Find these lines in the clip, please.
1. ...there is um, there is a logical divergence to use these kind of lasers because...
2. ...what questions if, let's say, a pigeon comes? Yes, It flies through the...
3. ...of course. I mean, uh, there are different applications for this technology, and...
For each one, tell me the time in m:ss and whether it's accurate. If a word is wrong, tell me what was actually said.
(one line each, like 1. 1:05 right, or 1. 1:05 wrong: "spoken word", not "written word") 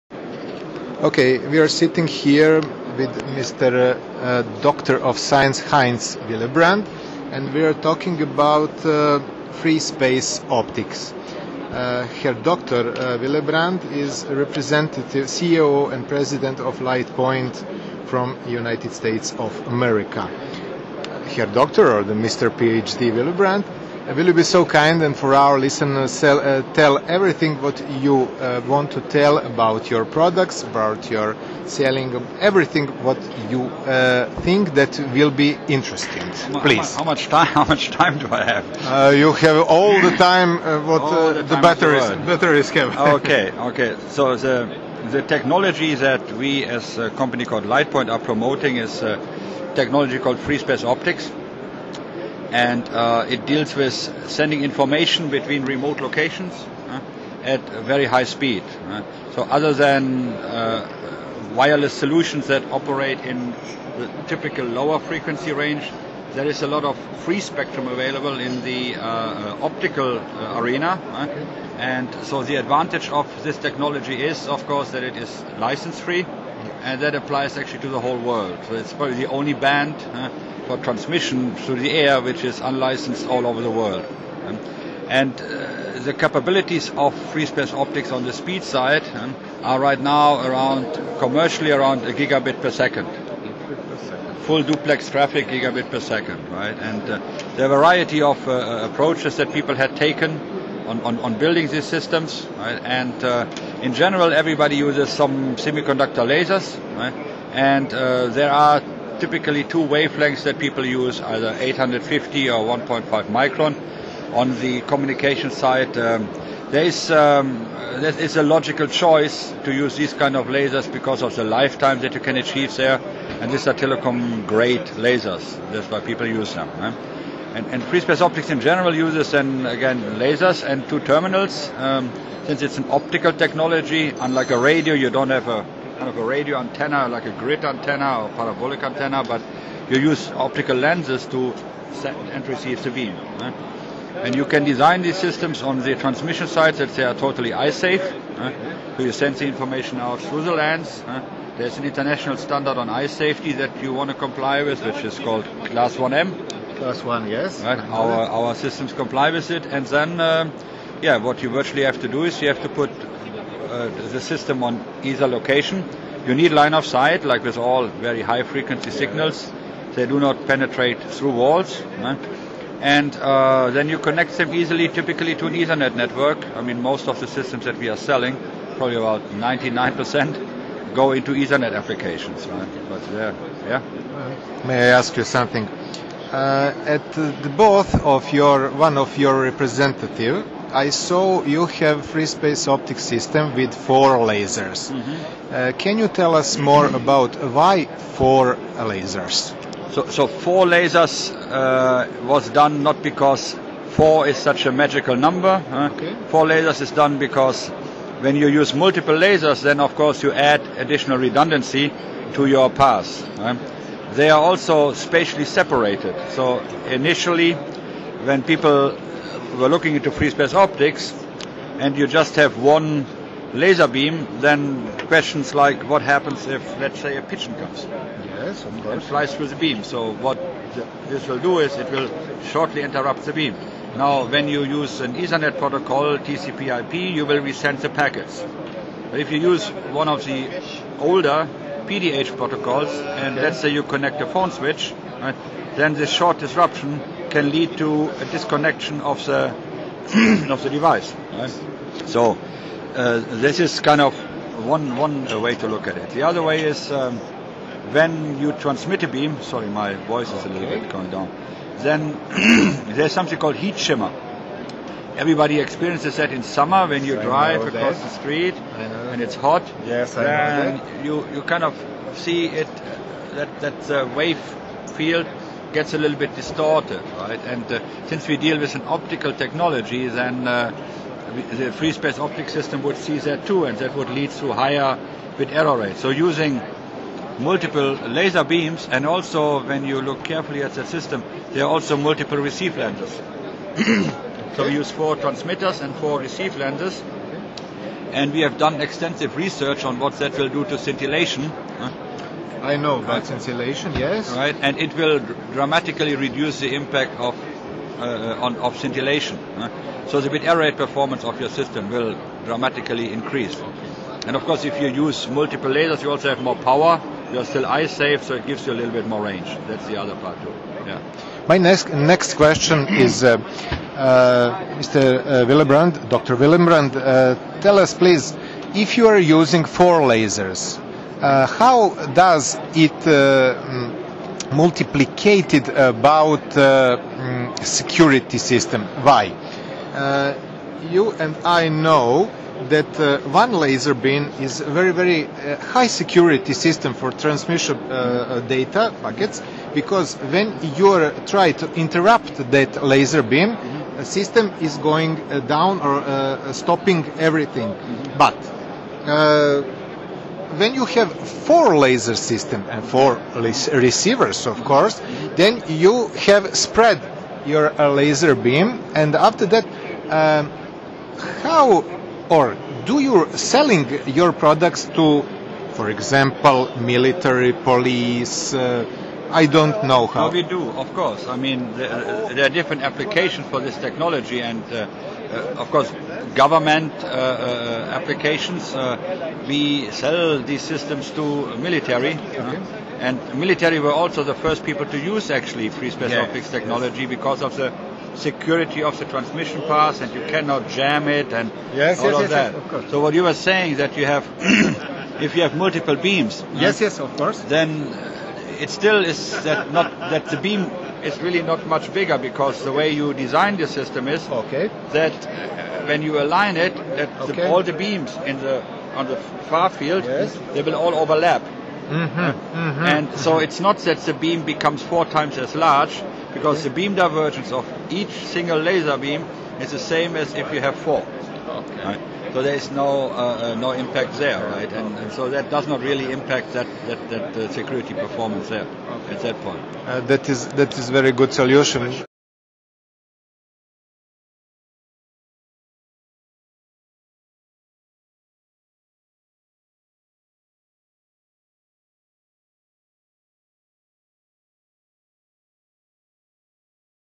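1. 1:56 wrong: "choice", not "divergence"
2. 3:45 wrong: "happens", not "questions"
3. 6:20 right.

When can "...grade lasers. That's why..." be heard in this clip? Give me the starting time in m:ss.
2:04.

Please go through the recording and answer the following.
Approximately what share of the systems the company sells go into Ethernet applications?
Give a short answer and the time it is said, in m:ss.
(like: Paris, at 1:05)
99%, at 2:59.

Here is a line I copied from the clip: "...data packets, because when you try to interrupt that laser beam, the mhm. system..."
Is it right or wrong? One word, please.
right.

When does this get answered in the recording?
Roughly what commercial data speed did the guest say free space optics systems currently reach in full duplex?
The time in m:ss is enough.
1:31.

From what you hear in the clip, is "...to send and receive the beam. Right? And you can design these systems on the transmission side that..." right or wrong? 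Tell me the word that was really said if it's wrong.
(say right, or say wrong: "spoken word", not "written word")
right.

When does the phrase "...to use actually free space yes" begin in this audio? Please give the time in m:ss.
6:34.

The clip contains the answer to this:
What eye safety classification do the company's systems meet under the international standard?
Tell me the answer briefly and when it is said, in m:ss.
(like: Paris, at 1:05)
Class 1M, at 2:35.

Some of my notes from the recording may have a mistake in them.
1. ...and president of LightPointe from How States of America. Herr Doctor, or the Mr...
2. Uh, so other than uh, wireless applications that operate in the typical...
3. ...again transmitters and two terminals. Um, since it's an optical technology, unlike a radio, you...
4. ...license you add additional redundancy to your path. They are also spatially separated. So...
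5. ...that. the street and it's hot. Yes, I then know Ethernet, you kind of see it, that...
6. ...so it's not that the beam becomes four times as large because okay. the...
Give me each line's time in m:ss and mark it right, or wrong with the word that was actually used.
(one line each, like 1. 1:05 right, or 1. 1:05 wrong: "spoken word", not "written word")
1. 0:15 wrong: "United", not "How"
2. 0:58 wrong: "solutions", not "applications"
3. 2:09 wrong: "lasers", not "transmitters"
4. 3:29 wrong: "course", not "license"
5. 4:27 wrong: "You", not "Ethernet"
6. 7:03 right.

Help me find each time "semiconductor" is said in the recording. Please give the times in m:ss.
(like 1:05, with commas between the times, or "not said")
1:45.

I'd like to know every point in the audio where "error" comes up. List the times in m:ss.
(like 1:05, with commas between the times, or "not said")
4:45, 5:10.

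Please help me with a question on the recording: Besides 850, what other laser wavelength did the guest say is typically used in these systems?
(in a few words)
1.5 micron.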